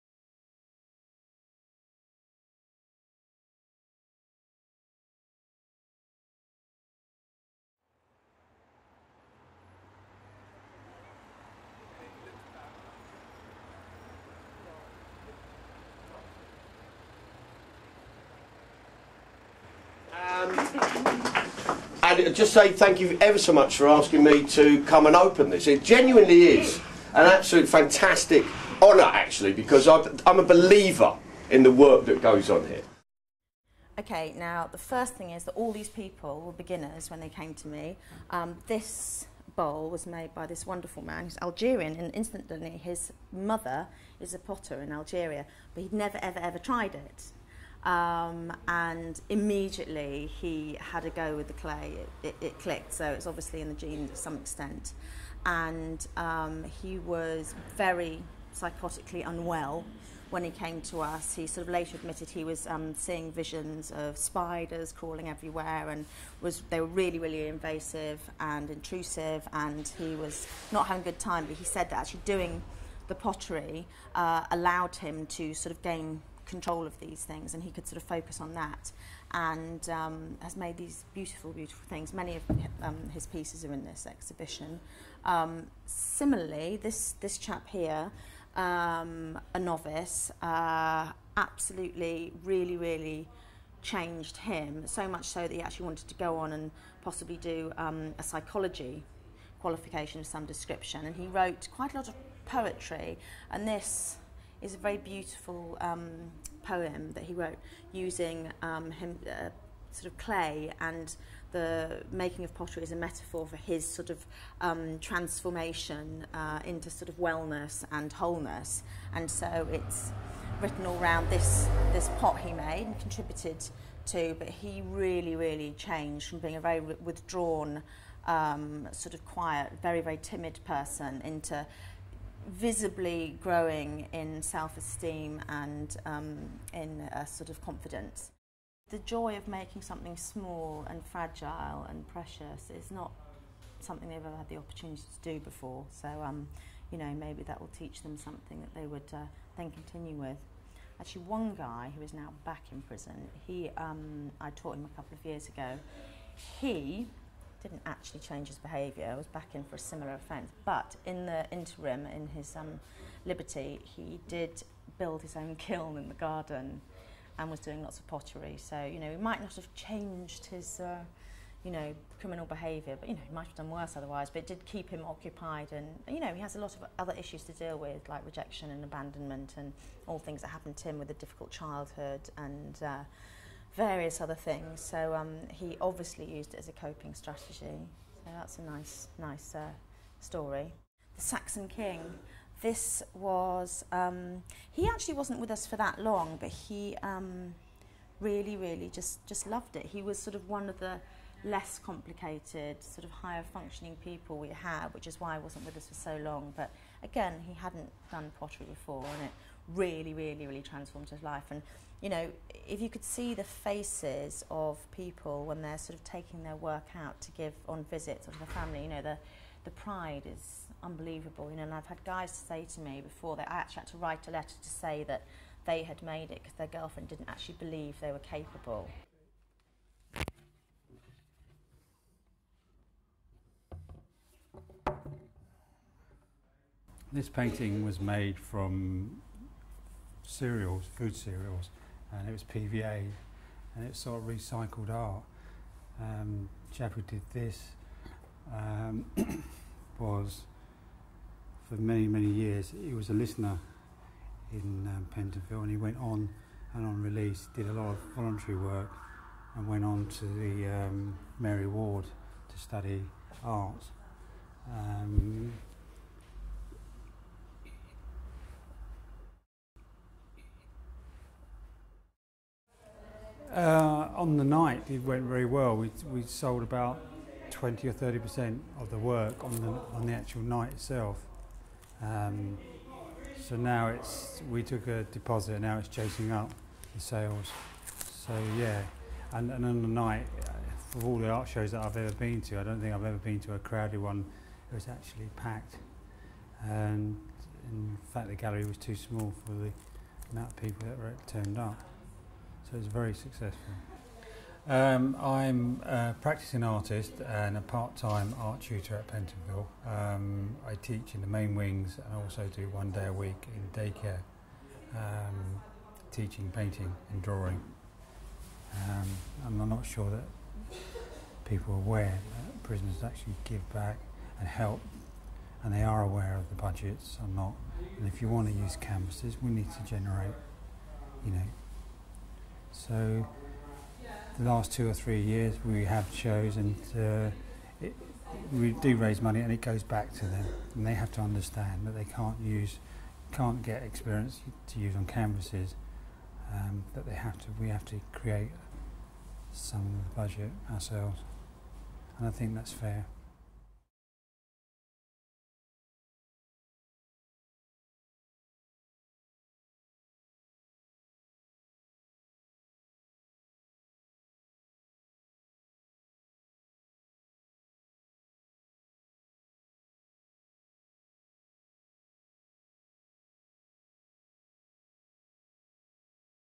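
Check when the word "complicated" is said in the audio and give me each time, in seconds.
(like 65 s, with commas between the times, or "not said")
201 s.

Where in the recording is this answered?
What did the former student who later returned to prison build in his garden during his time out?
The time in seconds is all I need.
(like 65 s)
165 s.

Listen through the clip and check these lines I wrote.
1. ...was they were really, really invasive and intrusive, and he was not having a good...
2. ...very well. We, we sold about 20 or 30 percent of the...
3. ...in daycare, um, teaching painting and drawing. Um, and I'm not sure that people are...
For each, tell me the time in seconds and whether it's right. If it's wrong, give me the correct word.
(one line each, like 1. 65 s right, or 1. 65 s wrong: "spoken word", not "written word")
1. 66 s right
2. 275 s right
3. 313 s right.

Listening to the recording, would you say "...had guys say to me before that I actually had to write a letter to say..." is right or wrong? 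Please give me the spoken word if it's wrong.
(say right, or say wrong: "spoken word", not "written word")
right.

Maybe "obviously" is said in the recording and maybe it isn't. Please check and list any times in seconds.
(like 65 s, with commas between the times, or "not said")
53 s, 185 s.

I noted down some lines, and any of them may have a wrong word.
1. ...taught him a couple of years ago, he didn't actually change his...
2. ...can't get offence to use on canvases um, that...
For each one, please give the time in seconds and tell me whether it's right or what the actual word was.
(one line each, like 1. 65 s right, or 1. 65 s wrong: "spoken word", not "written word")
1. 154 s right
2. 343 s wrong: "experience", not "offence".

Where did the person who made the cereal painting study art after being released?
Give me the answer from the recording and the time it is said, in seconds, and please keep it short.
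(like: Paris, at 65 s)
Mary Ward, at 261 s.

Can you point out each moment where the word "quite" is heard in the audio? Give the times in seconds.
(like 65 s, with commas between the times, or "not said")
101 s.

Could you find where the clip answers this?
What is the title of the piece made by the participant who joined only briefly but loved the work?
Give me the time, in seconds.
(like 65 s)
191 s.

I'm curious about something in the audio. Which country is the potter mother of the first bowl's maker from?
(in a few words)
Algeria.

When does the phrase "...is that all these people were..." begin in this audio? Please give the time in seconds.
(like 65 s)
35 s.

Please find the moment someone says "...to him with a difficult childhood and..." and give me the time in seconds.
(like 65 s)
180 s.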